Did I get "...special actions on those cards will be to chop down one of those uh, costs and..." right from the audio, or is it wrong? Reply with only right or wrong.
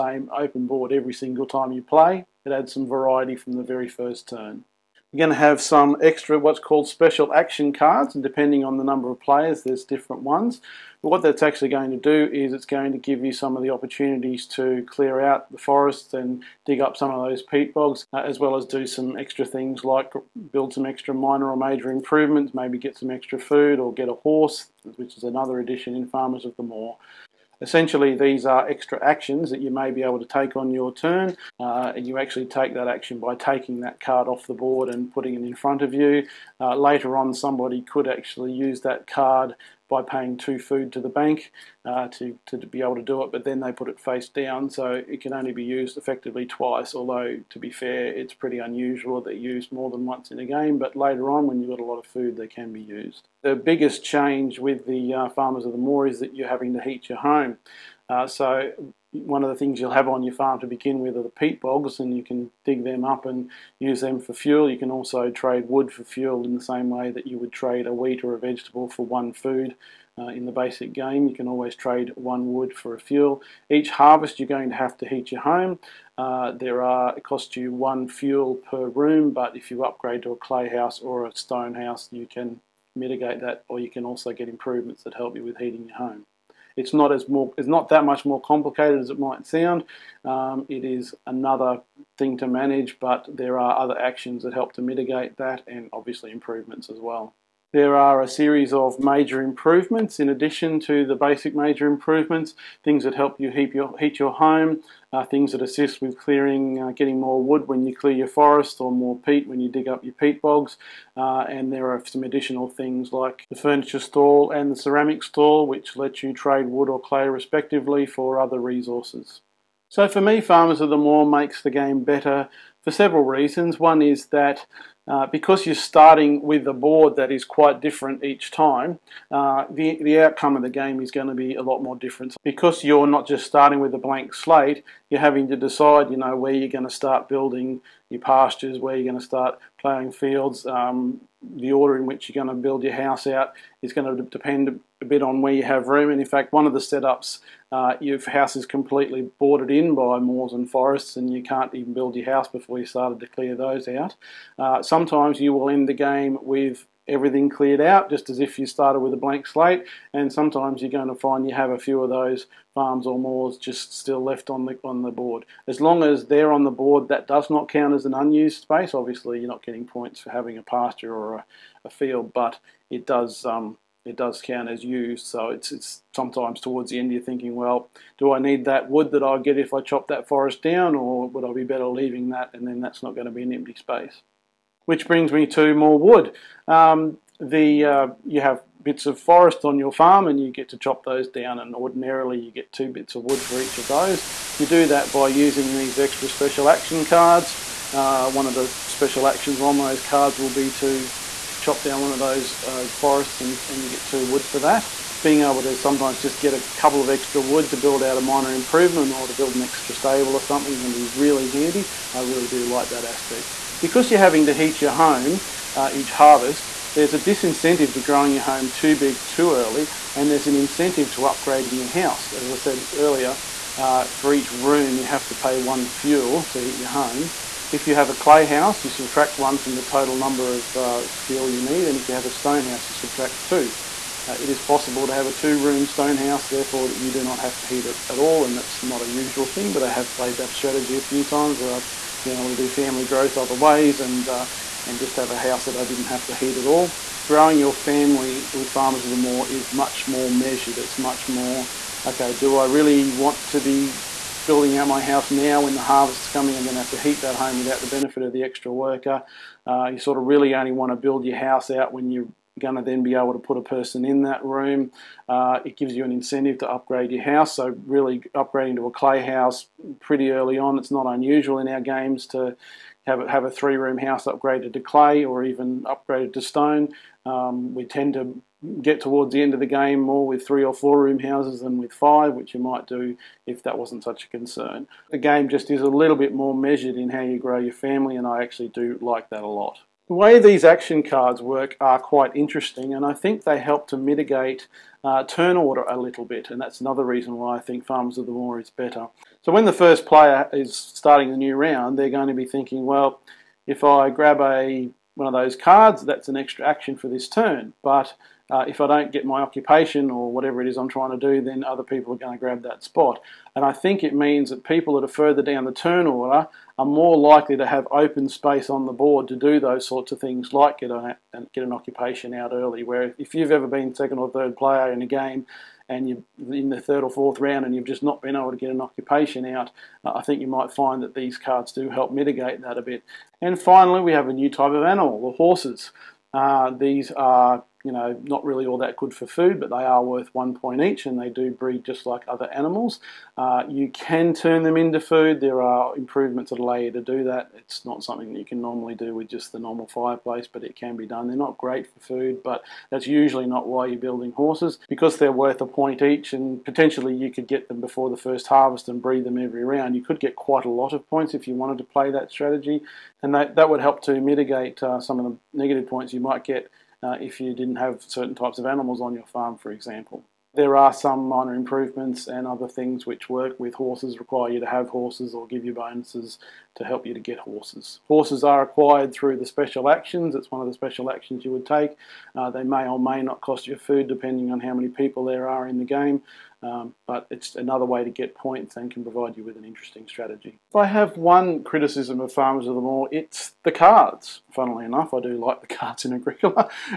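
wrong.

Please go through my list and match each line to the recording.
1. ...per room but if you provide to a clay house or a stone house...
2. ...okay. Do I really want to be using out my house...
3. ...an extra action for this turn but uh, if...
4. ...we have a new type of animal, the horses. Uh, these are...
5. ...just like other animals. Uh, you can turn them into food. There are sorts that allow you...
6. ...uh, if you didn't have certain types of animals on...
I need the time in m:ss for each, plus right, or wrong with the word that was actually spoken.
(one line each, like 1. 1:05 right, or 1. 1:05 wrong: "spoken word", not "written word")
1. 1:18 wrong: "upgrade", not "provide"
2. 4:12 wrong: "building", not "using"
3. 5:06 right
4. 5:34 right
5. 5:41 wrong: "improvements", not "sorts"
6. 6:07 right.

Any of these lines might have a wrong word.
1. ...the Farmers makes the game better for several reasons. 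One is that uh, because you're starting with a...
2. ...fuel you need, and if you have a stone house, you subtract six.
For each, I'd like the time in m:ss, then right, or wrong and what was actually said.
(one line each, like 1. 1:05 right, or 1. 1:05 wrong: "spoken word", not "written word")
1. 2:00 wrong: "Moor", not "Farmers"
2. 3:51 wrong: "two", not "six".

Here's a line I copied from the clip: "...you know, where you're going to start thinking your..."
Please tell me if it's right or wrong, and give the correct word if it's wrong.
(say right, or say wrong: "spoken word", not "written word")
wrong: "building", not "thinking".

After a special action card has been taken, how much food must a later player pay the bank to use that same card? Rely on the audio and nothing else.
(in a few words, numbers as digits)
2 food.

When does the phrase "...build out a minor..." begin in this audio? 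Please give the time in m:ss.
3:27.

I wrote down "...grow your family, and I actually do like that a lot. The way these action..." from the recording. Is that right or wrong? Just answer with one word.
right.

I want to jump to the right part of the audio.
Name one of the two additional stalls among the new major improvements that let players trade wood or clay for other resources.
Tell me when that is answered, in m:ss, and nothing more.
1:53.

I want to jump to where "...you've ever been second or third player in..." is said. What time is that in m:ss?
5:23.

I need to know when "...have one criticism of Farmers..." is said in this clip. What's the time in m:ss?
6:30.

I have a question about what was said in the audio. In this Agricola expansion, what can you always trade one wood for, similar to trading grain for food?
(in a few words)
a fuel.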